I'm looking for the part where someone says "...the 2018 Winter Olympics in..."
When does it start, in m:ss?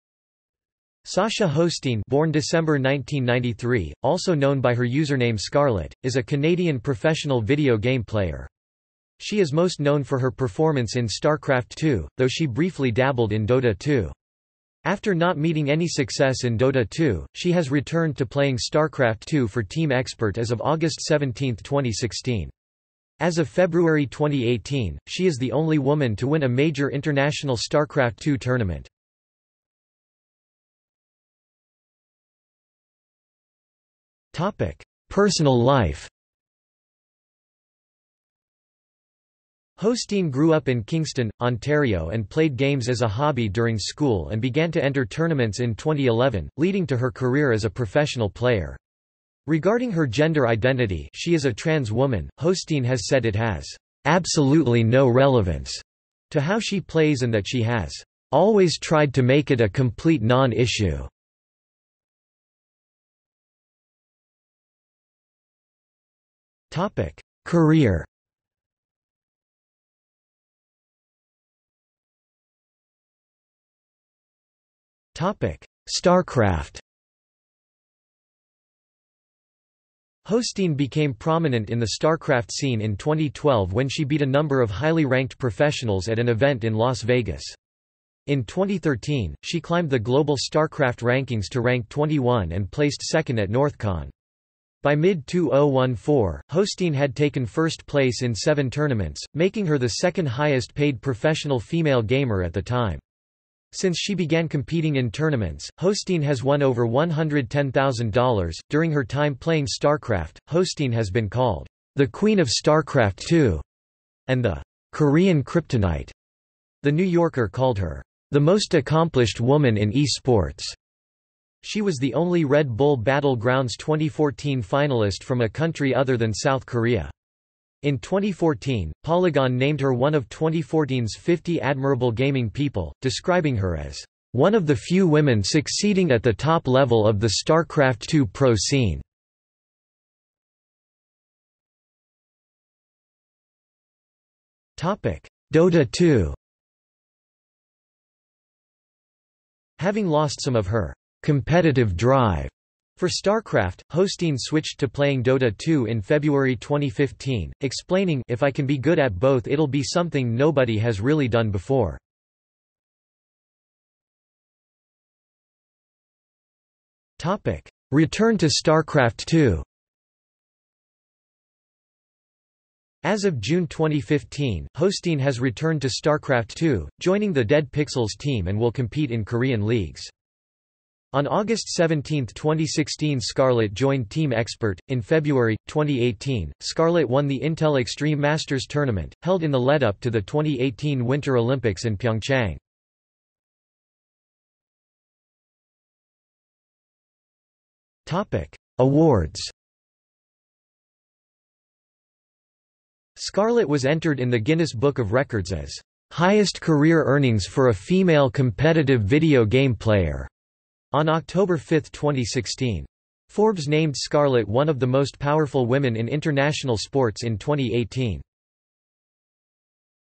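3:10.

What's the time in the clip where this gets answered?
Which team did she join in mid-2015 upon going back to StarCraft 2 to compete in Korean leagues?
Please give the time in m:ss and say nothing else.
2:57.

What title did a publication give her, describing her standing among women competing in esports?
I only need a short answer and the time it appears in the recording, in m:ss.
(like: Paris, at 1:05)
the most accomplished woman in esports, at 1:58.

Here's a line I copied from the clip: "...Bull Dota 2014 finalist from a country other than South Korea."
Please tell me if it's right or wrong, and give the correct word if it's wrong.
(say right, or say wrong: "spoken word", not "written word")
wrong: "Battlegrounds", not "Dota".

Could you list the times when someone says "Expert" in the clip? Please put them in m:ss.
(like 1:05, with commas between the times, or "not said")
0:19, 3:04.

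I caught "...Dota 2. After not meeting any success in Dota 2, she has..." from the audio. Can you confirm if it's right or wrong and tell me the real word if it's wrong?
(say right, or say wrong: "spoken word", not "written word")
right.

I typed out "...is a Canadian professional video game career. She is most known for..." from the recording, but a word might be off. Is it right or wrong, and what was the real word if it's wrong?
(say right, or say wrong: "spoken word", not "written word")
wrong: "player", not "career".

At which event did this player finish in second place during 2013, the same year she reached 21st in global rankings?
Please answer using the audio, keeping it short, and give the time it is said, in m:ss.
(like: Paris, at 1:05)
Northcon, at 1:33.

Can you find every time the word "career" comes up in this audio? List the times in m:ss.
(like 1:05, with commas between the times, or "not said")
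0:47, 1:07, 3:26.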